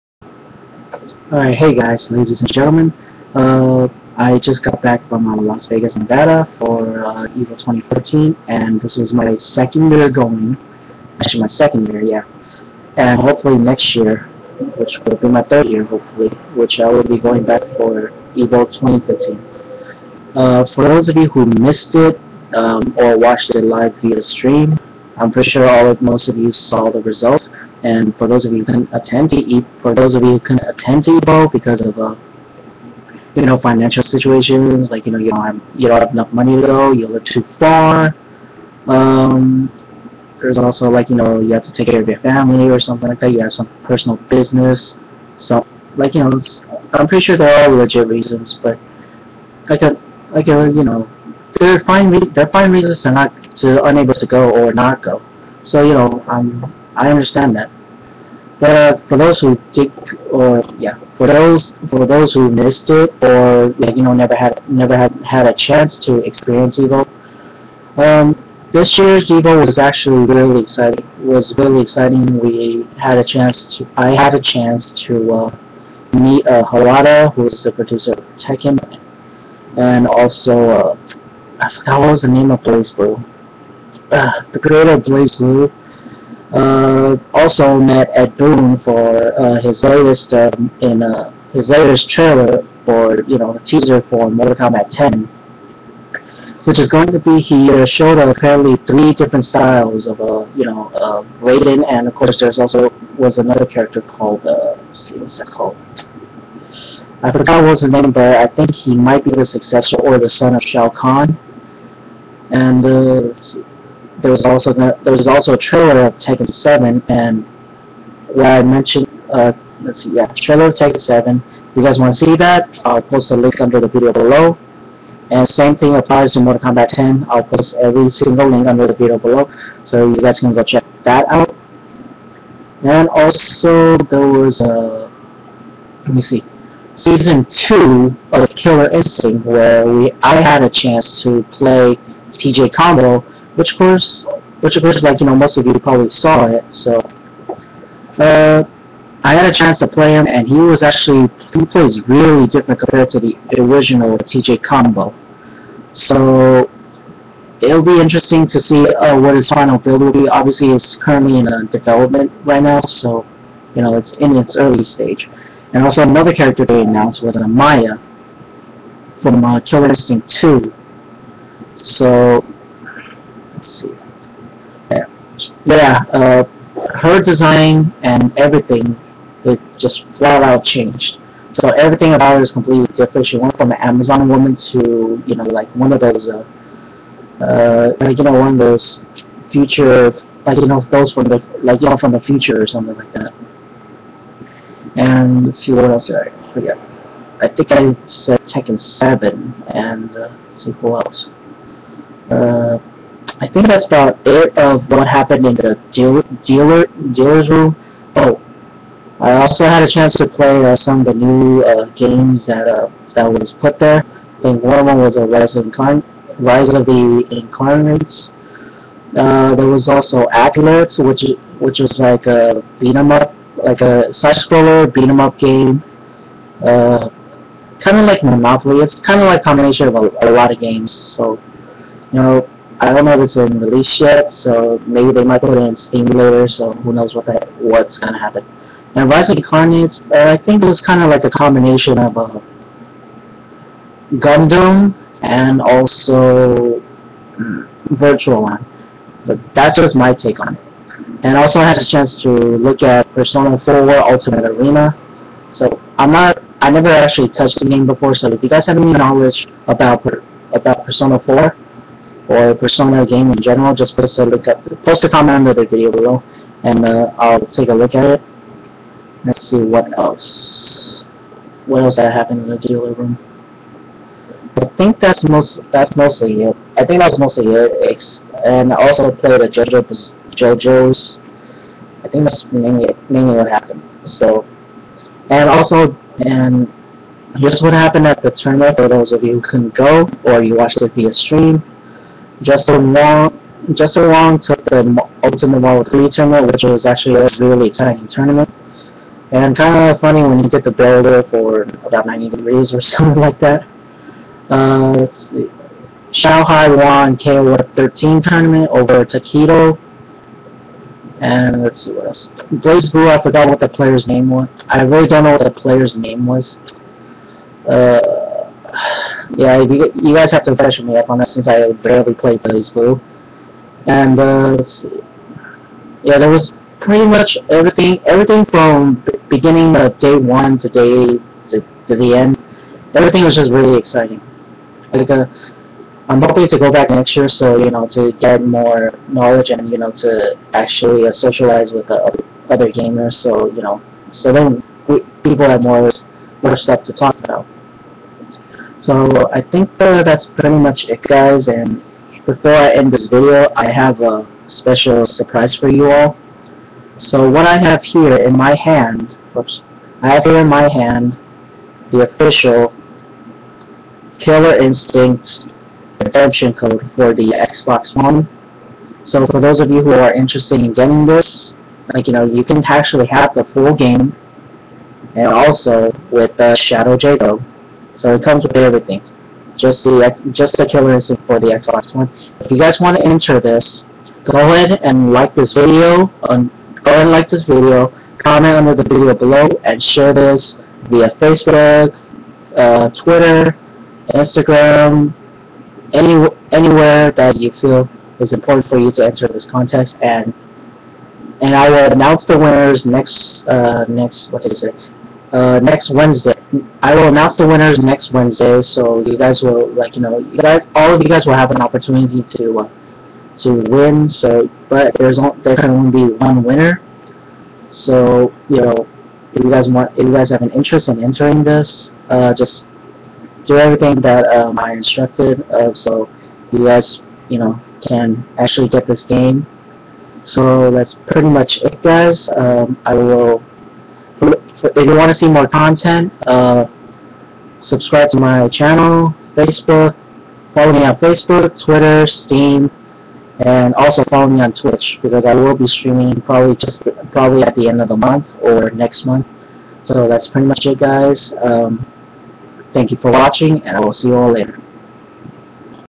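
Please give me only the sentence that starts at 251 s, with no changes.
And also I had a chance to look at Persona 4 Ultimate Arena.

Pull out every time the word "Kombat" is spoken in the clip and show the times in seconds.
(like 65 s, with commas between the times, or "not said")
94 s, 126 s.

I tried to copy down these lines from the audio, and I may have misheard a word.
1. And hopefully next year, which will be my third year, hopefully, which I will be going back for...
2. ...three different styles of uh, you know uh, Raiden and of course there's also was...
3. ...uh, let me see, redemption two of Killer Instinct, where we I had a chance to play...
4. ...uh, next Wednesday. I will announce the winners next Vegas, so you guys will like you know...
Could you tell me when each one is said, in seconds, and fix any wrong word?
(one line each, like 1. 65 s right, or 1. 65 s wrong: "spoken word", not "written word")
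1. 12 s right
2. 98 s right
3. 134 s wrong: "season", not "redemption"
4. 405 s wrong: "Wednesday", not "Vegas".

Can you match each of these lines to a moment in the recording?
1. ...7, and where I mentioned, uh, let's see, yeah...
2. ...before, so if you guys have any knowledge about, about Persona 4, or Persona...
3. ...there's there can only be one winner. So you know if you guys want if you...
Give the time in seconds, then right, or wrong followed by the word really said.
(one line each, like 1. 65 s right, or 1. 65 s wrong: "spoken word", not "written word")
1. 116 s right
2. 257 s right
3. 414 s right.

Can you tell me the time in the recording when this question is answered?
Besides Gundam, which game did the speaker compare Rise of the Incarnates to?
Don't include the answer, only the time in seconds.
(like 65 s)
247 s.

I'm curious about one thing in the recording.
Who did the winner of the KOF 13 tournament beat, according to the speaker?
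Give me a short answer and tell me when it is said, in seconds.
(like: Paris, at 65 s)
Taquito, at 309 s.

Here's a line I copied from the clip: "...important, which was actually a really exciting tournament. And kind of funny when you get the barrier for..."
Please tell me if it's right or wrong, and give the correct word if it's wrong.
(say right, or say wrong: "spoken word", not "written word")
wrong: "tournament", not "important".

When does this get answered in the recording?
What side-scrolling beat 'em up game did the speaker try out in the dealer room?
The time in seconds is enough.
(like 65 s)
220 s.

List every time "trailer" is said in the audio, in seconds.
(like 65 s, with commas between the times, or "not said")
92 s, 115 s, 120 s.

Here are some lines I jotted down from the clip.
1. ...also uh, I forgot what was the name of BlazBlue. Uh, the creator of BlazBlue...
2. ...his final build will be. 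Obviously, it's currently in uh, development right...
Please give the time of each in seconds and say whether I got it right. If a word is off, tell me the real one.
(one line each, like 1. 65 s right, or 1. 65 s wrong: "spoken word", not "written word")
1. 80 s right
2. 159 s right.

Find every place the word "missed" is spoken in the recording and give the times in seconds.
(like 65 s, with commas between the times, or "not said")
21 s, 62 s.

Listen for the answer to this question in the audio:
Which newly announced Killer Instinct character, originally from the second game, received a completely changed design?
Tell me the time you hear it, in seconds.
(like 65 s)
167 s.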